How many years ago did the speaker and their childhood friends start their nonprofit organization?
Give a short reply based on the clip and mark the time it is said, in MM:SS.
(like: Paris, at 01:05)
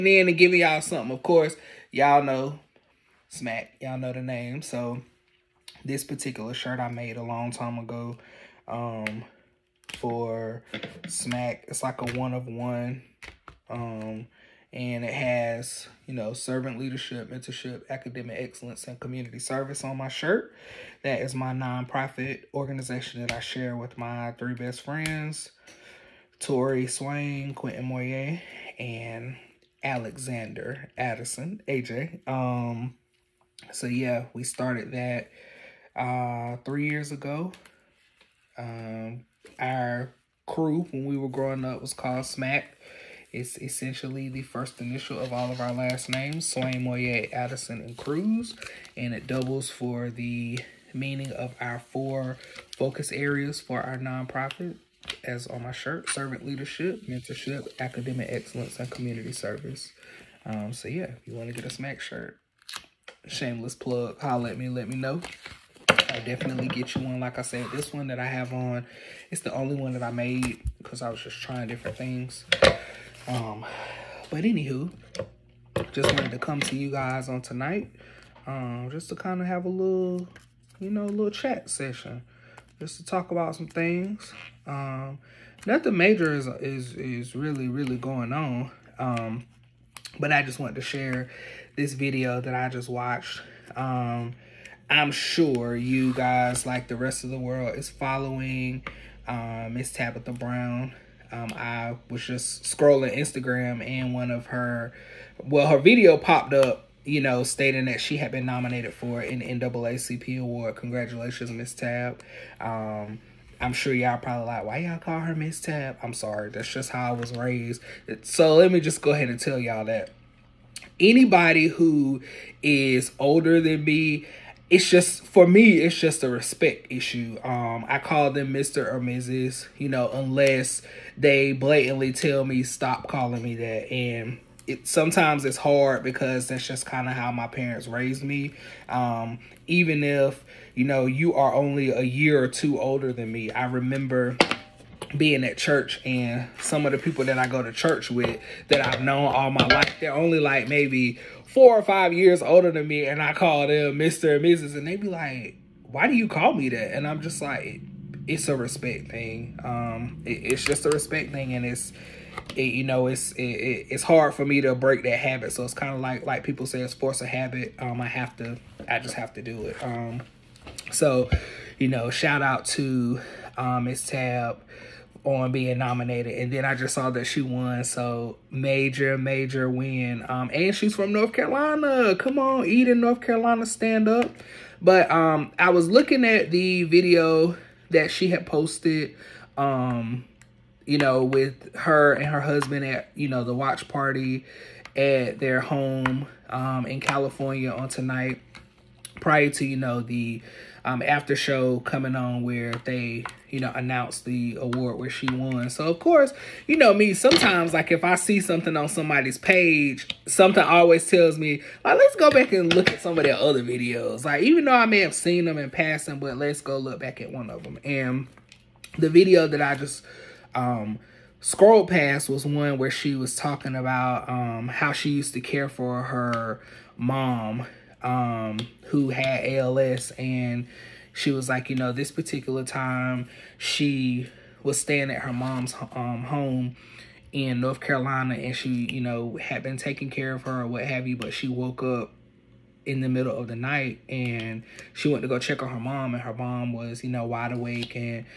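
3, at 00:36.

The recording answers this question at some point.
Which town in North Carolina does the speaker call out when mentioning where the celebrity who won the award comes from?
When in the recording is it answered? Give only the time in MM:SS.
03:02.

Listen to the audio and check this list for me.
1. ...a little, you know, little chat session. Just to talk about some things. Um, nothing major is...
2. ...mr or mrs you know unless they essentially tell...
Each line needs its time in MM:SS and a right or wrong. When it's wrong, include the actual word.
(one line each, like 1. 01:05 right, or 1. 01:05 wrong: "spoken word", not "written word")
1. 01:19 right
2. 02:08 wrong: "blatantly", not "essentially".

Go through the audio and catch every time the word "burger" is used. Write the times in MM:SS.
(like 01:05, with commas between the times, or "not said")
not said.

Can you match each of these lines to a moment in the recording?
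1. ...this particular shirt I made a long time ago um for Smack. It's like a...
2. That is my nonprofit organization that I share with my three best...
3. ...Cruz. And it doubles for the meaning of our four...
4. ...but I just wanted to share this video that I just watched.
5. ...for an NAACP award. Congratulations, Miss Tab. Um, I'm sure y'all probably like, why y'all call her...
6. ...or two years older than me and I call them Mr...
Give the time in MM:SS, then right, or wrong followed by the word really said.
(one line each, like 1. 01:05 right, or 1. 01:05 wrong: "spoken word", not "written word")
1. 00:05 right
2. 00:21 right
3. 00:47 right
4. 01:30 right
5. 01:48 right
6. 02:31 wrong: "five", not "two".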